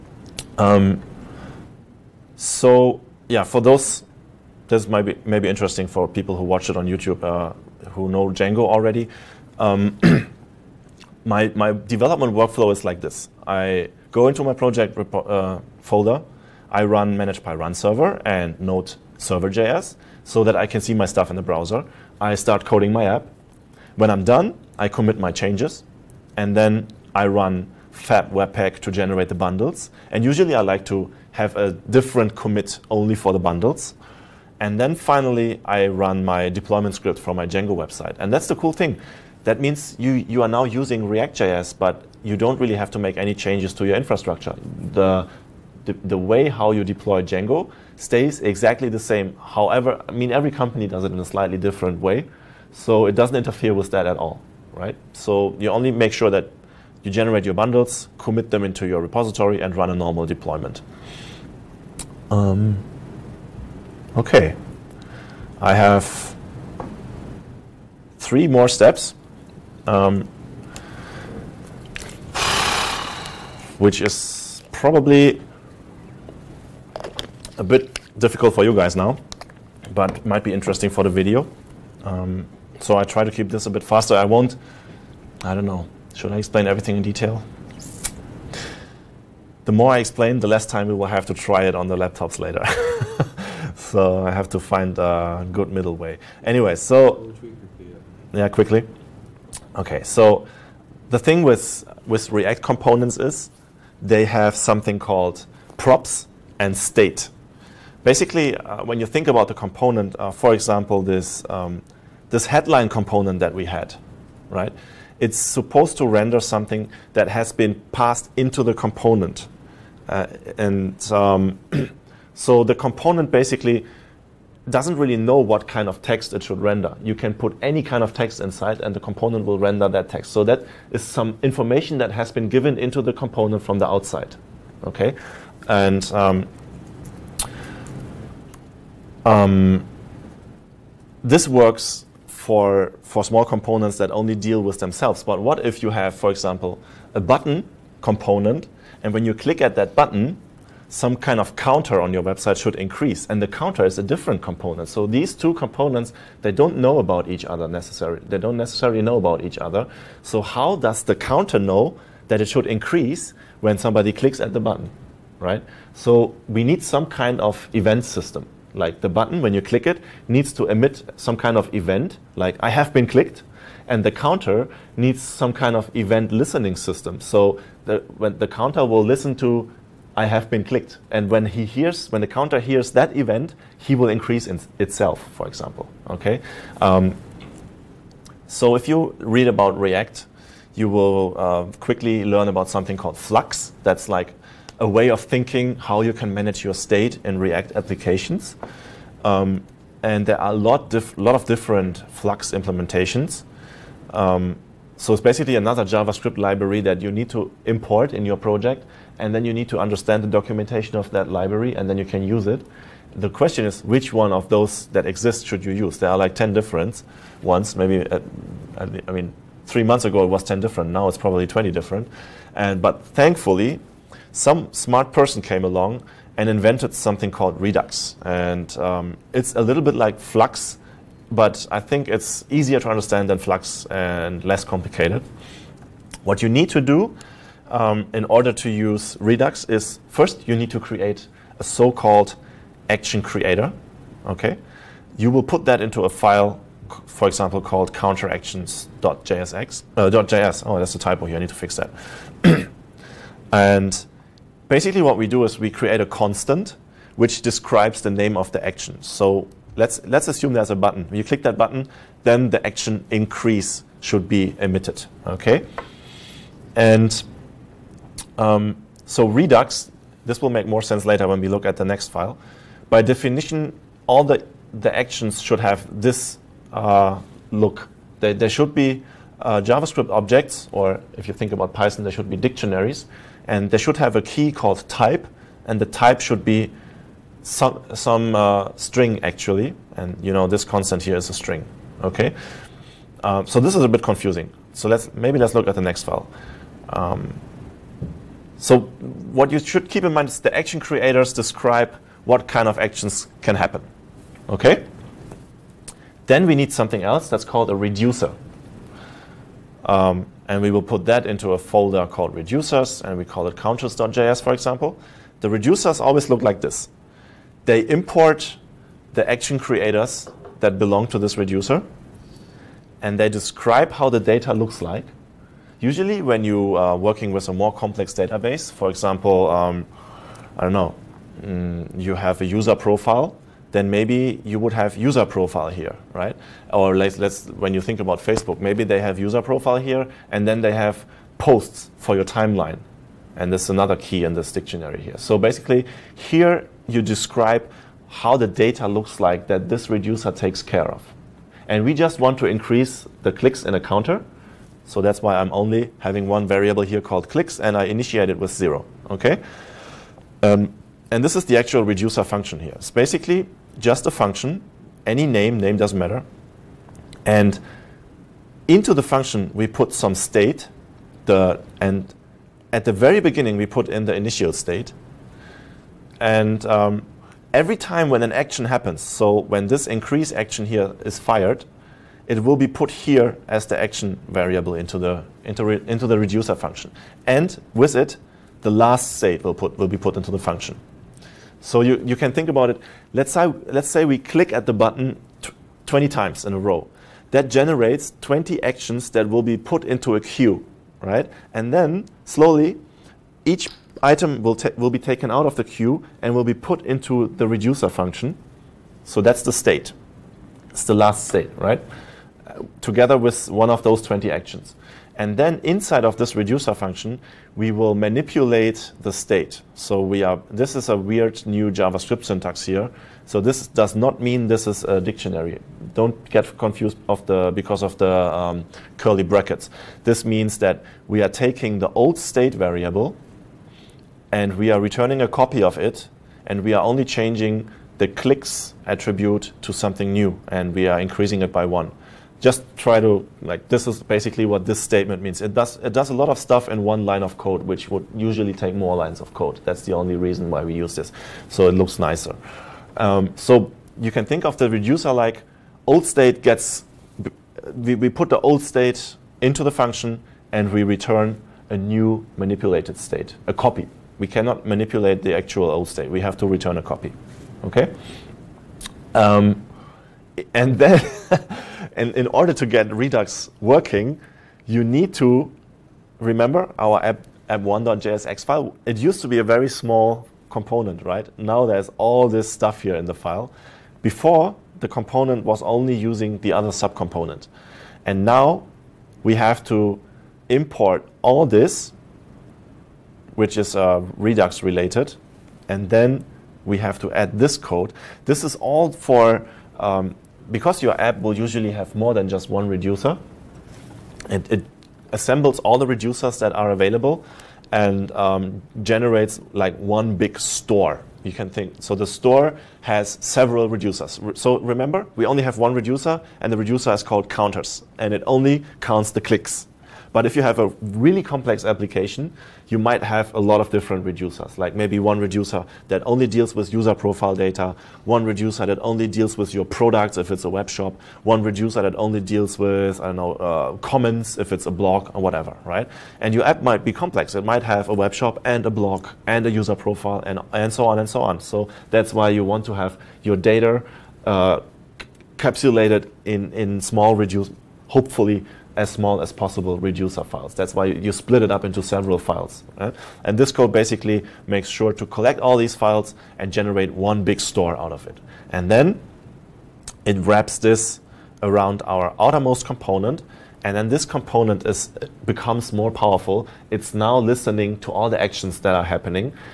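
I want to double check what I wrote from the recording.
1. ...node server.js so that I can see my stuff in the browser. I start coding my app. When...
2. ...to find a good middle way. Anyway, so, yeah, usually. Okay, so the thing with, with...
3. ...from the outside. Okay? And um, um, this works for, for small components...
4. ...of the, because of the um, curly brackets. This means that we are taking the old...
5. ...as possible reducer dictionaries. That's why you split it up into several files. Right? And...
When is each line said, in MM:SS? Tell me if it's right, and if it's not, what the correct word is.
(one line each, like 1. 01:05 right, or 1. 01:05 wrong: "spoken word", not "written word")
1. 00:18 right
2. 01:34 wrong: "quickly", not "usually"
3. 02:13 right
4. 07:07 right
5. 09:09 wrong: "files", not "dictionaries".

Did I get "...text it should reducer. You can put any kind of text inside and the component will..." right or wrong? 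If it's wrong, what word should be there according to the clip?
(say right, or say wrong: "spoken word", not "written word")
wrong: "render", not "reducer".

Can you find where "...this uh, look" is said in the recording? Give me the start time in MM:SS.
04:36.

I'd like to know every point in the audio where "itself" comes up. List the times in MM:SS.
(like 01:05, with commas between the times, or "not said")
03:04.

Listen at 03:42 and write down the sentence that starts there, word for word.
And, but thankfully, some smart person came along and invented something called Redux.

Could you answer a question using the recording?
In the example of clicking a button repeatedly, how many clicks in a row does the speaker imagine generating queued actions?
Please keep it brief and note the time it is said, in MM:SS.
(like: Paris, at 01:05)
20, at 06:35.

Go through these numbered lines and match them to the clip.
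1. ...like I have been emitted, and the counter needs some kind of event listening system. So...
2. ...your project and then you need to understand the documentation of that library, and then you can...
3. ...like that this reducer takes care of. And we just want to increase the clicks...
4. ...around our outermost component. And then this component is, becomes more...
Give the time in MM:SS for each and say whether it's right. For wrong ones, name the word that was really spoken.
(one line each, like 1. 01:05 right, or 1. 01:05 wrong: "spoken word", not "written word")
1. 02:52 wrong: "clicked", not "emitted"
2. 03:28 right
3. 05:49 right
4. 09:21 right.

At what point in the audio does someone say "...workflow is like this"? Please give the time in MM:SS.
00:12.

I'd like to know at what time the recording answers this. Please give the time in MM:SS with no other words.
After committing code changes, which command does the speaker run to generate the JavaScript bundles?
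00:27.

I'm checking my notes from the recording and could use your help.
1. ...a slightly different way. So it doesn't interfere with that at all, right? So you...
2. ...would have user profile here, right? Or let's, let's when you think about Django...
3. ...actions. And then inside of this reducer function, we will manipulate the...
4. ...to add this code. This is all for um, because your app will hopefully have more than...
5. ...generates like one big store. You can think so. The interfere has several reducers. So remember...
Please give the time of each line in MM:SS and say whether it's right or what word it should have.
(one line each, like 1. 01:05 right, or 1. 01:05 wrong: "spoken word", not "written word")
1. 00:51 right
2. 05:34 wrong: "Facebook", not "Django"
3. 06:54 right
4. 08:17 wrong: "usually", not "hopefully"
5. 08:28 wrong: "store", not "interfere".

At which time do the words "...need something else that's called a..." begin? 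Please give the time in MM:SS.
05:06.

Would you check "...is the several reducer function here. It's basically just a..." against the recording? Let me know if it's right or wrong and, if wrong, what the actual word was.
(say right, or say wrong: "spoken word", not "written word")
wrong: "actual", not "several".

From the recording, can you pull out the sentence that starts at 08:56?
And your app might be complex.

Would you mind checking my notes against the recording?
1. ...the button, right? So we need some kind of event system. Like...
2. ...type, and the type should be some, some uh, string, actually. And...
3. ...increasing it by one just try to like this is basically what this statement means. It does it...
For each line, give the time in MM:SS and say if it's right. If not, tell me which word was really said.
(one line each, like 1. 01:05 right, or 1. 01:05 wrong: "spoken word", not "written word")
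1. 02:44 right
2. 04:44 right
3. 07:20 right.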